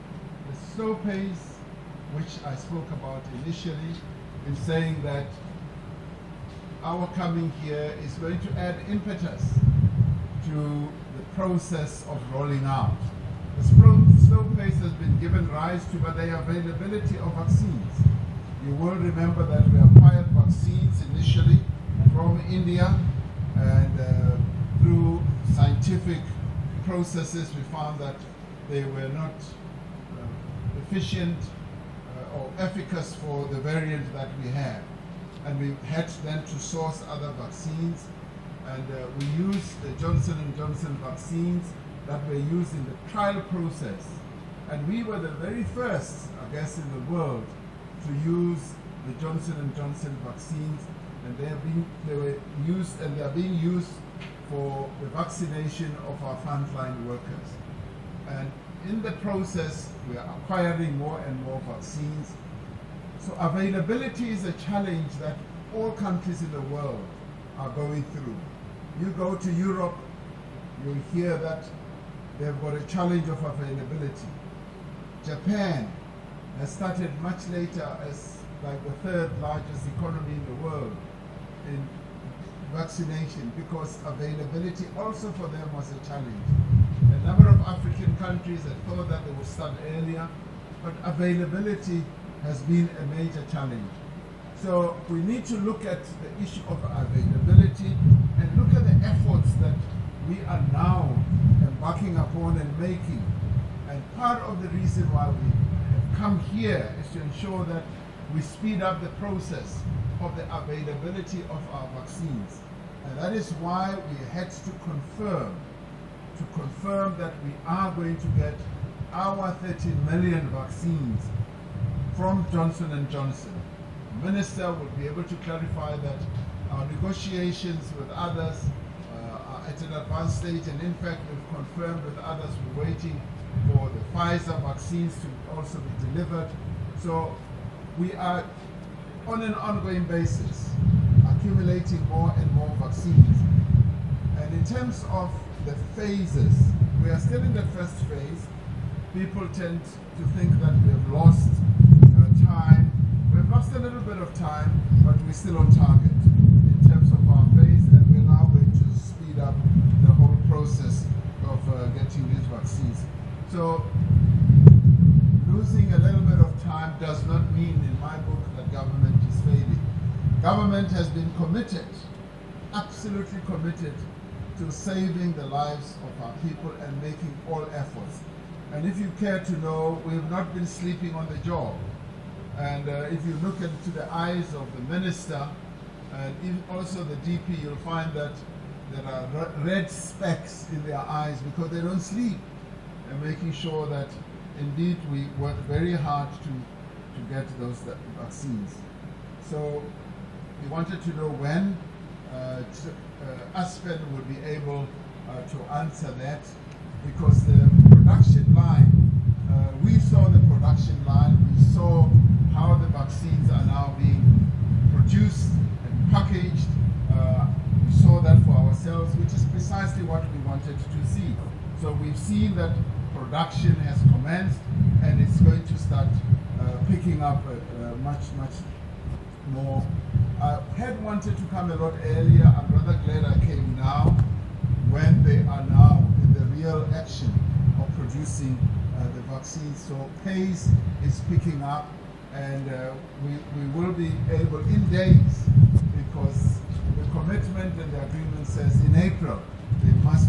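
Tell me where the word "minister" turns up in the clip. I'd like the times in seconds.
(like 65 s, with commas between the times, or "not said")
124 s, 184 s.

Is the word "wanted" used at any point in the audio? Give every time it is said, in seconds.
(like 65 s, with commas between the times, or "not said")
200 s, 220 s, 231 s.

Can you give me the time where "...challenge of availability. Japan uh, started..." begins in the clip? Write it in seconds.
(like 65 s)
72 s.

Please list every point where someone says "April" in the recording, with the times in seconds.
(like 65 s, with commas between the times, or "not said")
248 s.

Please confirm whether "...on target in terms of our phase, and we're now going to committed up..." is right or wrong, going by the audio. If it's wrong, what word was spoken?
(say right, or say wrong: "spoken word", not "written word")
wrong: "speed", not "committed".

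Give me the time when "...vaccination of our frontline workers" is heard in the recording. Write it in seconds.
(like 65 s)
55 s.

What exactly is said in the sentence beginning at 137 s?
So we are on an ongoing basis accumulating more and more vaccines.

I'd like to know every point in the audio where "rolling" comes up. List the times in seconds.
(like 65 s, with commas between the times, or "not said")
12 s.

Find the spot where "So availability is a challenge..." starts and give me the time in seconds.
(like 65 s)
63 s.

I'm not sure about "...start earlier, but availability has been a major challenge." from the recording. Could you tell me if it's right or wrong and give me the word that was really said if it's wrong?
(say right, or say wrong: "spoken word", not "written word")
right.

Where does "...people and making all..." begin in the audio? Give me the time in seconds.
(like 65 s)
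176 s.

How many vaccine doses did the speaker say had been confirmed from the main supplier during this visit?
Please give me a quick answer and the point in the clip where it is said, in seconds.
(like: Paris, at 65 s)
30 million, at 119 s.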